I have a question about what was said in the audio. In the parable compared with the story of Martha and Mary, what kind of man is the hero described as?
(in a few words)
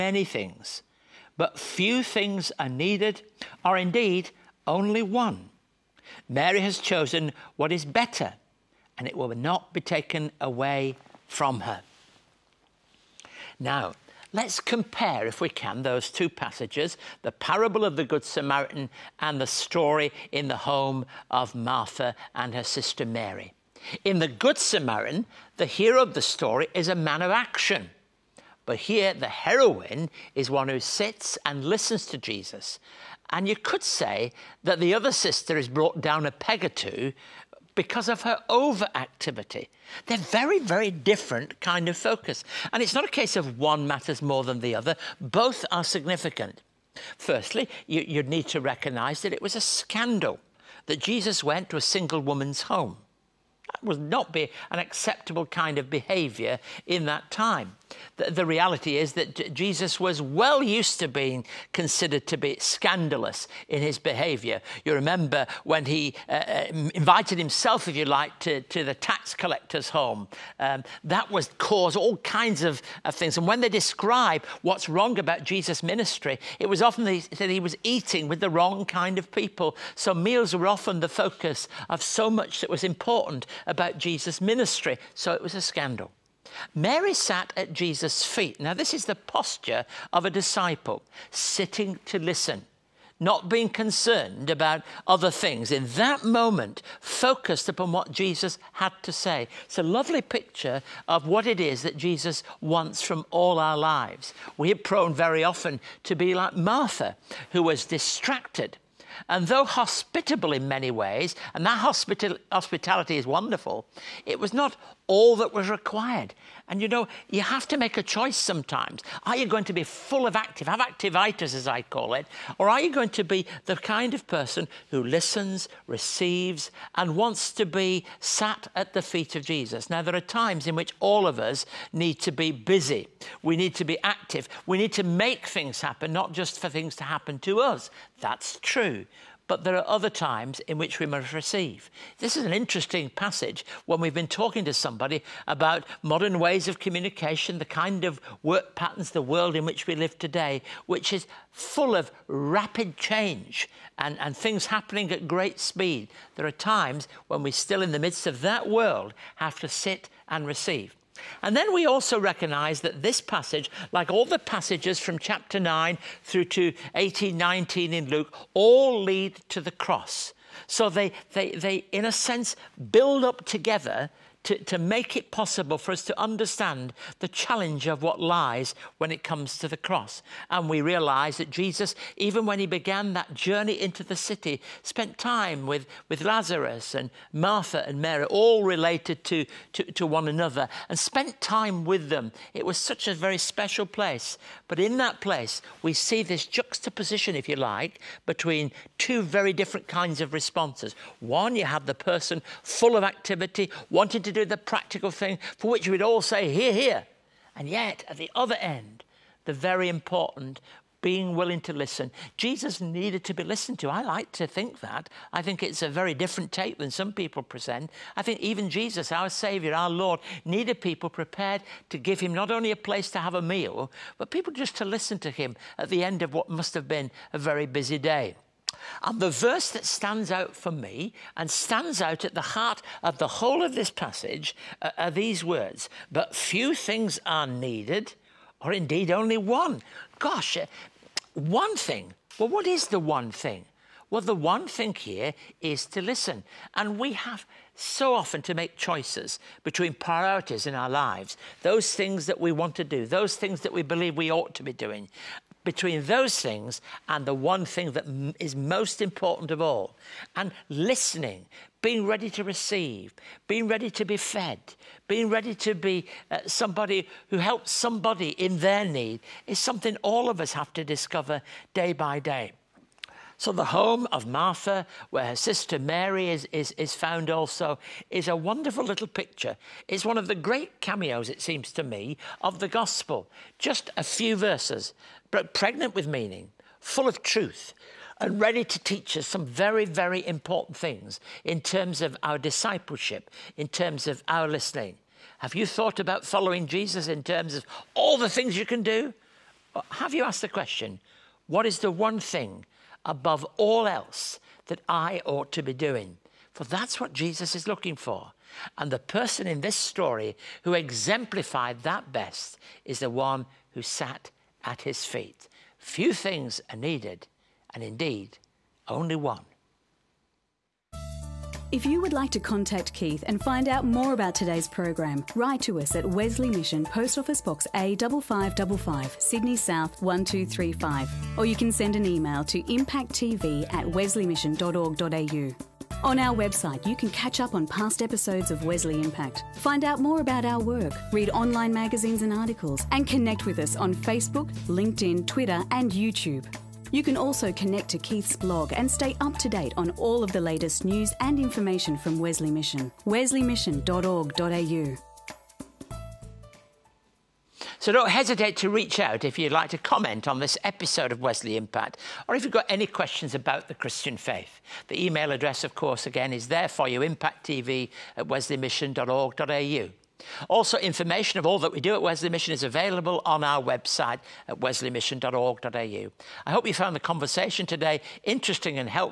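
a man of action.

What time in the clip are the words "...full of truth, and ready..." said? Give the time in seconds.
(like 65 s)
286 s.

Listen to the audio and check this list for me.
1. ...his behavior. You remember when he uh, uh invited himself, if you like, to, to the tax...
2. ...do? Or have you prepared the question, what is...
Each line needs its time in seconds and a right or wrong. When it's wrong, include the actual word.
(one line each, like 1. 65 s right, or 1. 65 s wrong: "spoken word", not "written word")
1. 63 s right
2. 298 s wrong: "asked", not "prepared".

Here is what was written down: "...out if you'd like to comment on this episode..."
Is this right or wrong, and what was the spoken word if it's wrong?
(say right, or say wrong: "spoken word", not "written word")
right.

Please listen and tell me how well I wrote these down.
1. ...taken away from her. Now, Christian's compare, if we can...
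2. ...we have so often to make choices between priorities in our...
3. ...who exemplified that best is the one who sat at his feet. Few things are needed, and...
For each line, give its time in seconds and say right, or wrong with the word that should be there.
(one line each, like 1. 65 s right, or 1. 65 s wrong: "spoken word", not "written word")
1. 9 s wrong: "Let", not "Christian"
2. 246 s right
3. 310 s right.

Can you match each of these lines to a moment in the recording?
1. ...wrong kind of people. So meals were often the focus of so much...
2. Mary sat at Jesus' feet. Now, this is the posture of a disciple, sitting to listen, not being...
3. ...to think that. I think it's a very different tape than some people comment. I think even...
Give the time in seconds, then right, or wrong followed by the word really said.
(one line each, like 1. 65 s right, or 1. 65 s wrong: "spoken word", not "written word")
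1. 78 s right
2. 86 s right
3. 214 s wrong: "present", not "comment".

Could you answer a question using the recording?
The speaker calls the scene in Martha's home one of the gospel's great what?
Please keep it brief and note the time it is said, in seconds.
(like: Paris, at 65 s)
cameos, at 280 s.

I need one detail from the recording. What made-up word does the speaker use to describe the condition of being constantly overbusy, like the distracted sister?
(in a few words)
activitis.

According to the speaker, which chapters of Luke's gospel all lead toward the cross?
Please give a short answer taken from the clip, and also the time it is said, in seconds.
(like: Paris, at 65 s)
Chapter 9 through to 18, 19, at 165 s.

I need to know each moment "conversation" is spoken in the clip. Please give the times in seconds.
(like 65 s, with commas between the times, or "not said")
377 s.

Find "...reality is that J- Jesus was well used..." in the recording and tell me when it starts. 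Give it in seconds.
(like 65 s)
58 s.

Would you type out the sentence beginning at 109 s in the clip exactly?
And though hospitable in many ways, and that hospital, hospitality is wonderful, it was not all that was required.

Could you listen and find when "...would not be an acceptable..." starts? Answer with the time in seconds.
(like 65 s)
53 s.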